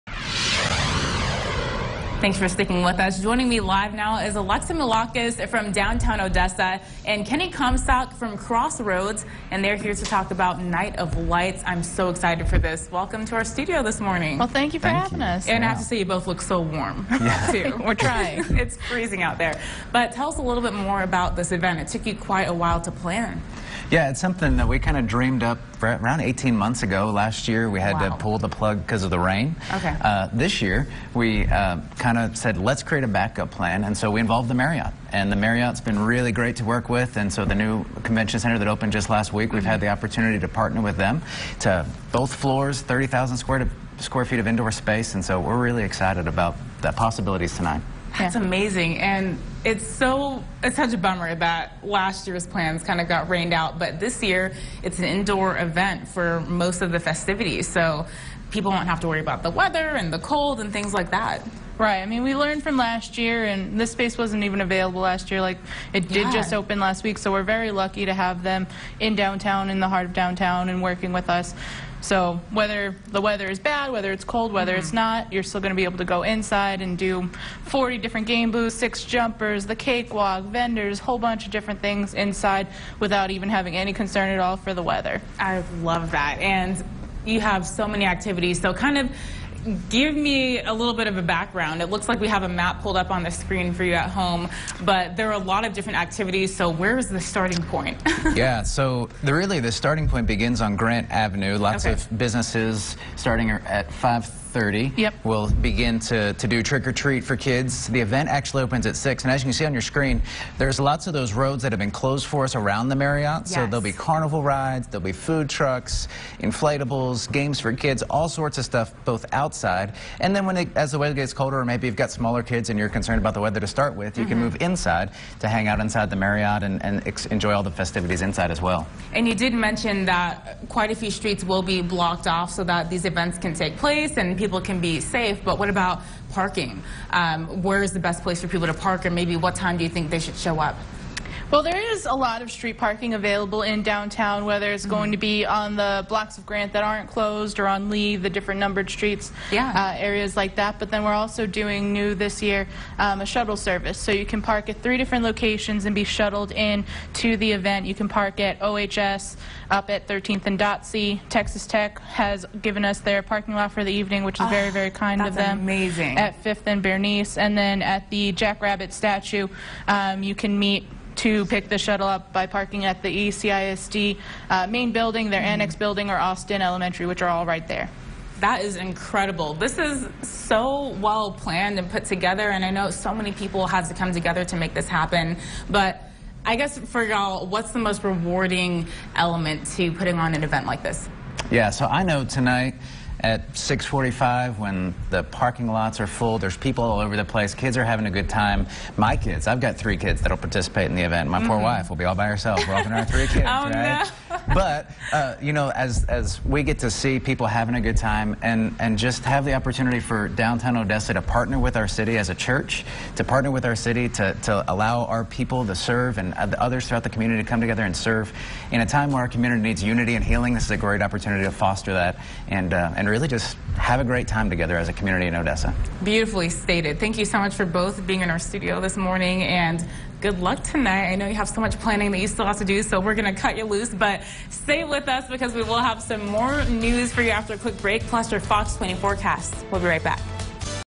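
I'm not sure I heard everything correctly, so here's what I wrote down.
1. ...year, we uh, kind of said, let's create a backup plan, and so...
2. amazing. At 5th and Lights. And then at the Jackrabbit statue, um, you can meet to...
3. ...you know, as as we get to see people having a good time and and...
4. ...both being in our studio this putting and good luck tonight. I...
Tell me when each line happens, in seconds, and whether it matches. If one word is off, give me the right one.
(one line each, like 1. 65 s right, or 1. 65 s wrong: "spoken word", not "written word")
1. 30 s right
2. 165 s wrong: "Bernice", not "Lights"
3. 205 s right
4. 227 s wrong: "morning", not "putting".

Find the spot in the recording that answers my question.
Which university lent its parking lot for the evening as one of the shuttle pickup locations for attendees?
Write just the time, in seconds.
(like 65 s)
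161 s.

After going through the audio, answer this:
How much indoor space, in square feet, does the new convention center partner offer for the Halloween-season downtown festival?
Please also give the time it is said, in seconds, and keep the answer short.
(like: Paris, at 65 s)
30,000 square feet, at 42 s.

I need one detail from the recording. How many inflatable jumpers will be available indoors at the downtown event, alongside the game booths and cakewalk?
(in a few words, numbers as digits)
6.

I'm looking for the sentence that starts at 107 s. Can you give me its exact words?
The event actually opens at 6.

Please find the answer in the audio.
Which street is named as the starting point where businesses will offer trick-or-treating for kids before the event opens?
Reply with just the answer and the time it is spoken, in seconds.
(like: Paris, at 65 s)
Grant Avenue, at 100 s.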